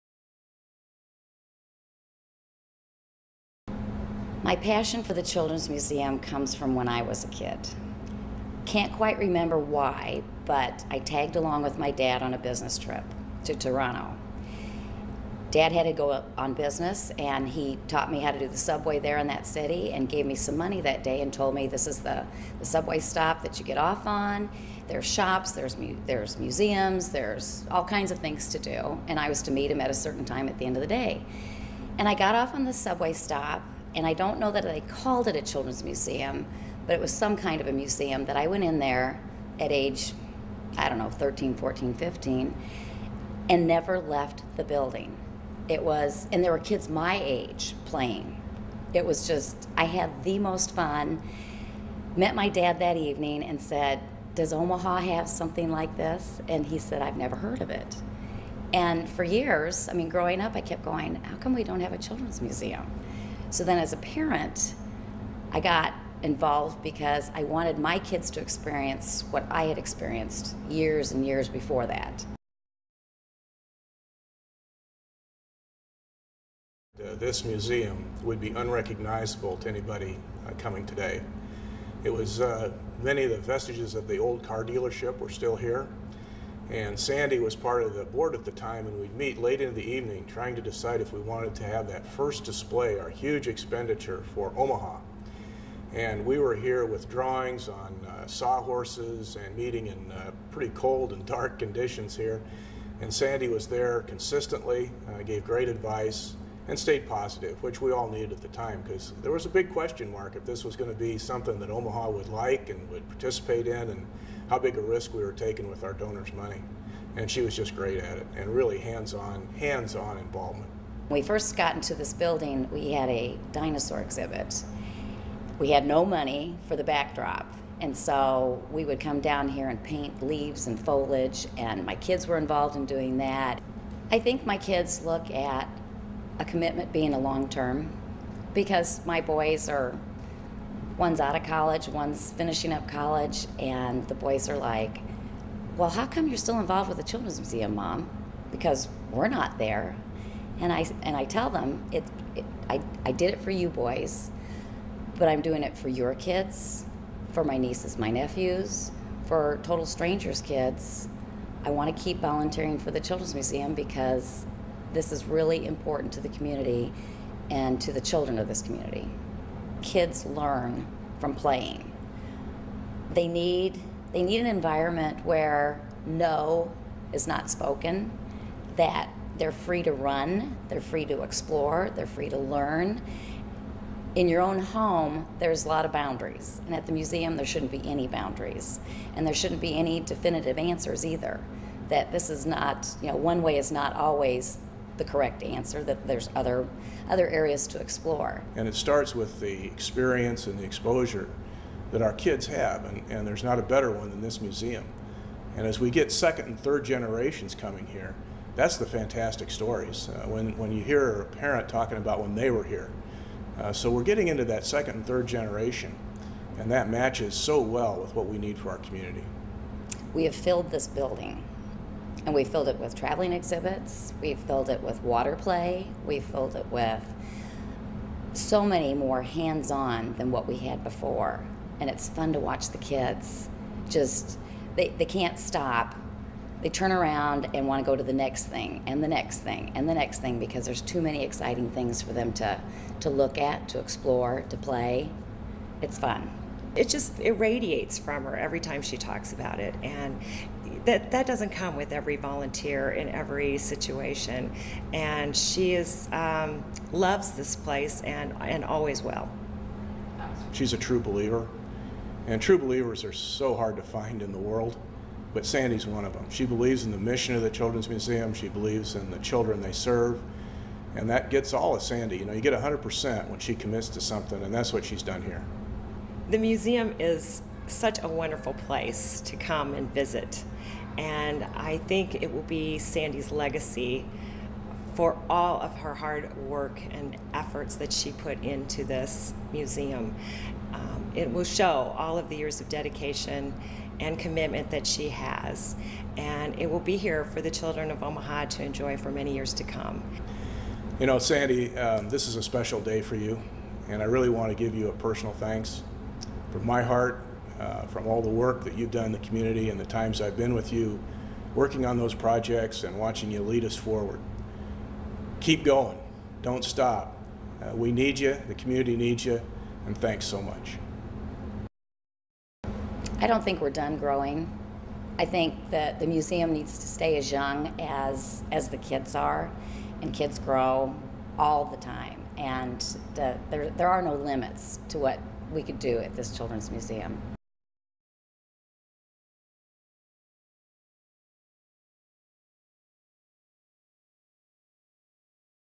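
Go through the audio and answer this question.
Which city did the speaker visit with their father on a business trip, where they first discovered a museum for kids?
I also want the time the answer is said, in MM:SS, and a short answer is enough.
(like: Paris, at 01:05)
Toronto, at 00:13.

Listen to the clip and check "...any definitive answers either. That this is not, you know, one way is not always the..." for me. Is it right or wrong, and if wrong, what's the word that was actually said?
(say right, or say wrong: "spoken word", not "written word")
right.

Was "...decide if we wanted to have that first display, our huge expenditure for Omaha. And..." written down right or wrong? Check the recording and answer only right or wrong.
right.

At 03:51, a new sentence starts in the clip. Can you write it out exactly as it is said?
And it's fun to watch the kids just, they, they can't stop.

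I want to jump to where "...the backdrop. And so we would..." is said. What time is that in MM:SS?
02:06.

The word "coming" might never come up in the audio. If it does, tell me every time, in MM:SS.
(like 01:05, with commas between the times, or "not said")
01:20, 03:27.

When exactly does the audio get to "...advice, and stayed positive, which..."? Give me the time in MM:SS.
01:45.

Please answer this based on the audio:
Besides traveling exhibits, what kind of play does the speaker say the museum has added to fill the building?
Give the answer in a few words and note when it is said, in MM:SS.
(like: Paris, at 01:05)
Water play, at 03:45.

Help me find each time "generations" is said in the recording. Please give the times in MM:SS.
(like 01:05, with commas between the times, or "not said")
03:26, 03:35.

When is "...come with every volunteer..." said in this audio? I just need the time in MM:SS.
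04:11.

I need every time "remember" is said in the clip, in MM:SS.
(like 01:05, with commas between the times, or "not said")
00:09.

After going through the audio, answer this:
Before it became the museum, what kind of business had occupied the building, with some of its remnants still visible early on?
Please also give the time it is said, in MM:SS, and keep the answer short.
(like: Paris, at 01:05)
Car dealership, at 01:24.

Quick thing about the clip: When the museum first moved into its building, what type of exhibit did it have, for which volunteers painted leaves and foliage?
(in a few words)
Dinosaur exhibit.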